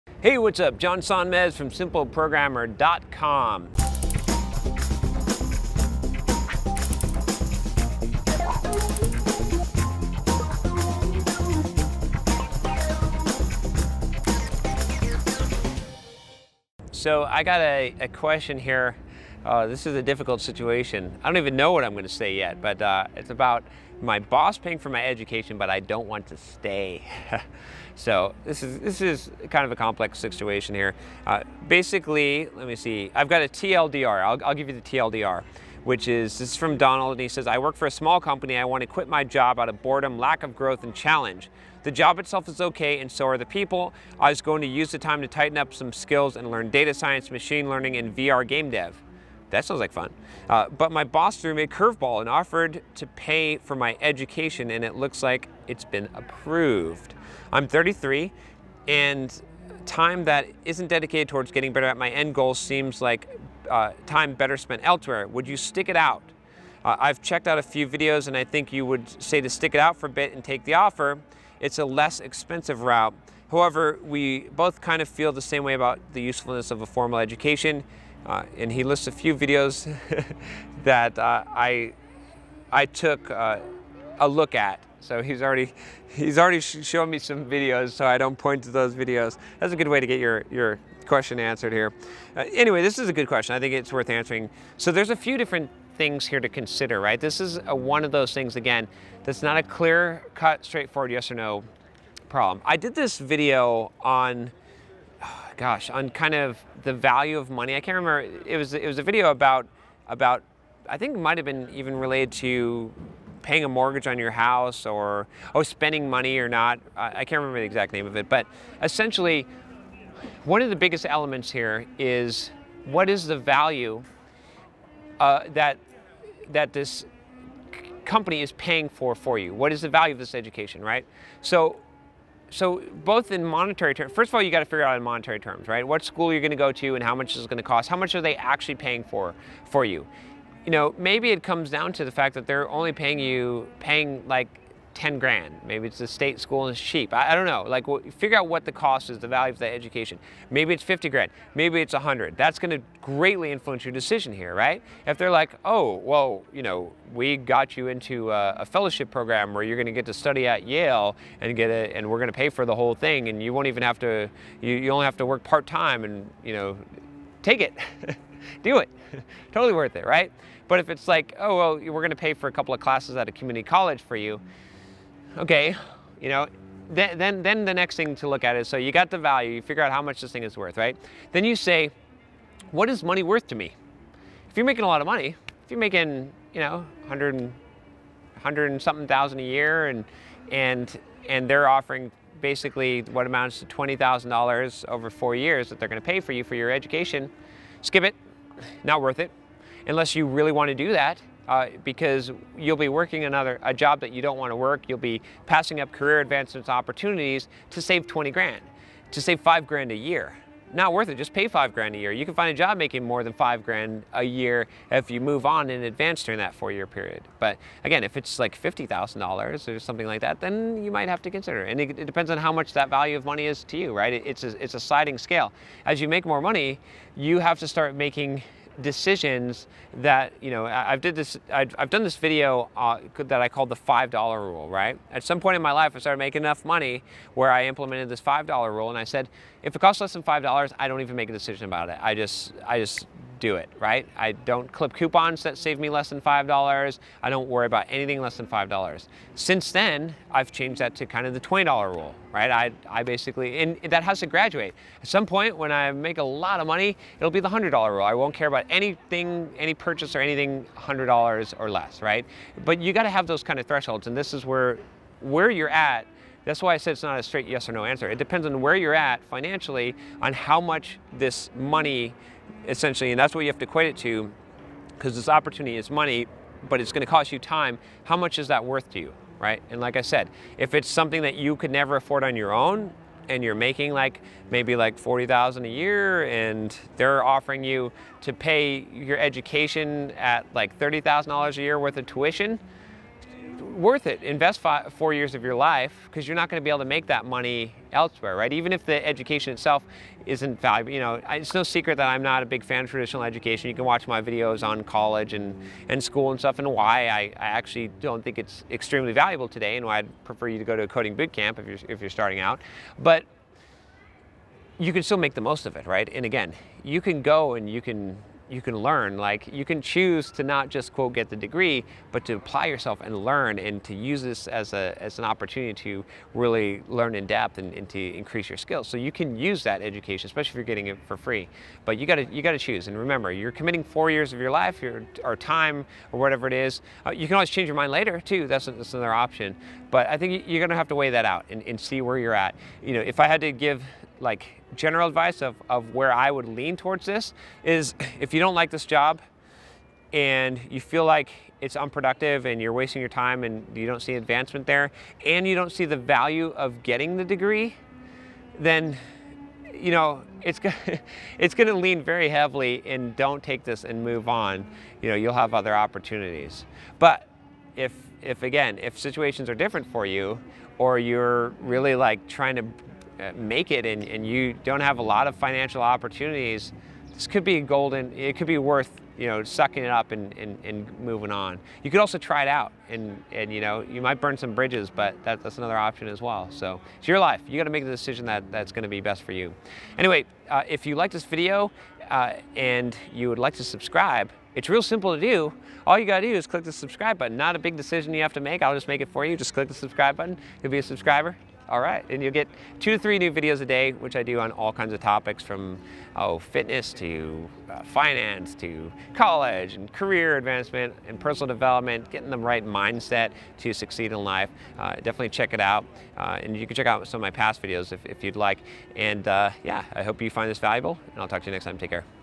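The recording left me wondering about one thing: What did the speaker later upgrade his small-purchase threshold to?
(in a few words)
$20.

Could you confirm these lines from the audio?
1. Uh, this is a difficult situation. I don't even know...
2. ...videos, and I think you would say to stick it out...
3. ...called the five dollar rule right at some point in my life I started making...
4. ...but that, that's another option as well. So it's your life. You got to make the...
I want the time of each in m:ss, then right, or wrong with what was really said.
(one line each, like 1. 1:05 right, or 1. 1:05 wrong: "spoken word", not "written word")
1. 0:19 right
2. 1:07 right
3. 3:53 right
4. 6:24 right.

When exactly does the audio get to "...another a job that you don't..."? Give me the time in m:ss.
3:23.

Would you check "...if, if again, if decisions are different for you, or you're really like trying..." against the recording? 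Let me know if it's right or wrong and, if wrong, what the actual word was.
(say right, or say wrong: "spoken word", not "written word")
wrong: "situations", not "decisions".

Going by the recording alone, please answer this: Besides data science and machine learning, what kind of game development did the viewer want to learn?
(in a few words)
VR game dev.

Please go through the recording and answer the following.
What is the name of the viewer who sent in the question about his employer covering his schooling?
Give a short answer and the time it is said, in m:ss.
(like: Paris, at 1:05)
Donald, at 0:36.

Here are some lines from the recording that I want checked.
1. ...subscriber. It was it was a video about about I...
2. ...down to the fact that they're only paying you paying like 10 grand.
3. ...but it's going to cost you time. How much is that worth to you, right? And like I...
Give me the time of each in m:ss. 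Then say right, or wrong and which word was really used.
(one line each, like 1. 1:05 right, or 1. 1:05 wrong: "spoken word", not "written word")
1. 1:47 wrong: "remember", not "subscriber"
2. 2:21 right
3. 4:36 right.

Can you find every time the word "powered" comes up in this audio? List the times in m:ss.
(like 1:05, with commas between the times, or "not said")
not said.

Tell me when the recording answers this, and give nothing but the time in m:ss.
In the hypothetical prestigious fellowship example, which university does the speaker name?
2:40.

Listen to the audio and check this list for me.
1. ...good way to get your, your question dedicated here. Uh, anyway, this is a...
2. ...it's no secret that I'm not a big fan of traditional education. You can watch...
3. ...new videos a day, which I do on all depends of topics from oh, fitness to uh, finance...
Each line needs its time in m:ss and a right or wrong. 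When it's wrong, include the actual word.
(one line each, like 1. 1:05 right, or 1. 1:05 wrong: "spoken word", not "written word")
1. 1:29 wrong: "answered", not "dedicated"
2. 5:01 right
3. 6:43 wrong: "kinds", not "depends".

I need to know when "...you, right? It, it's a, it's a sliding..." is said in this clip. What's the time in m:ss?
3:43.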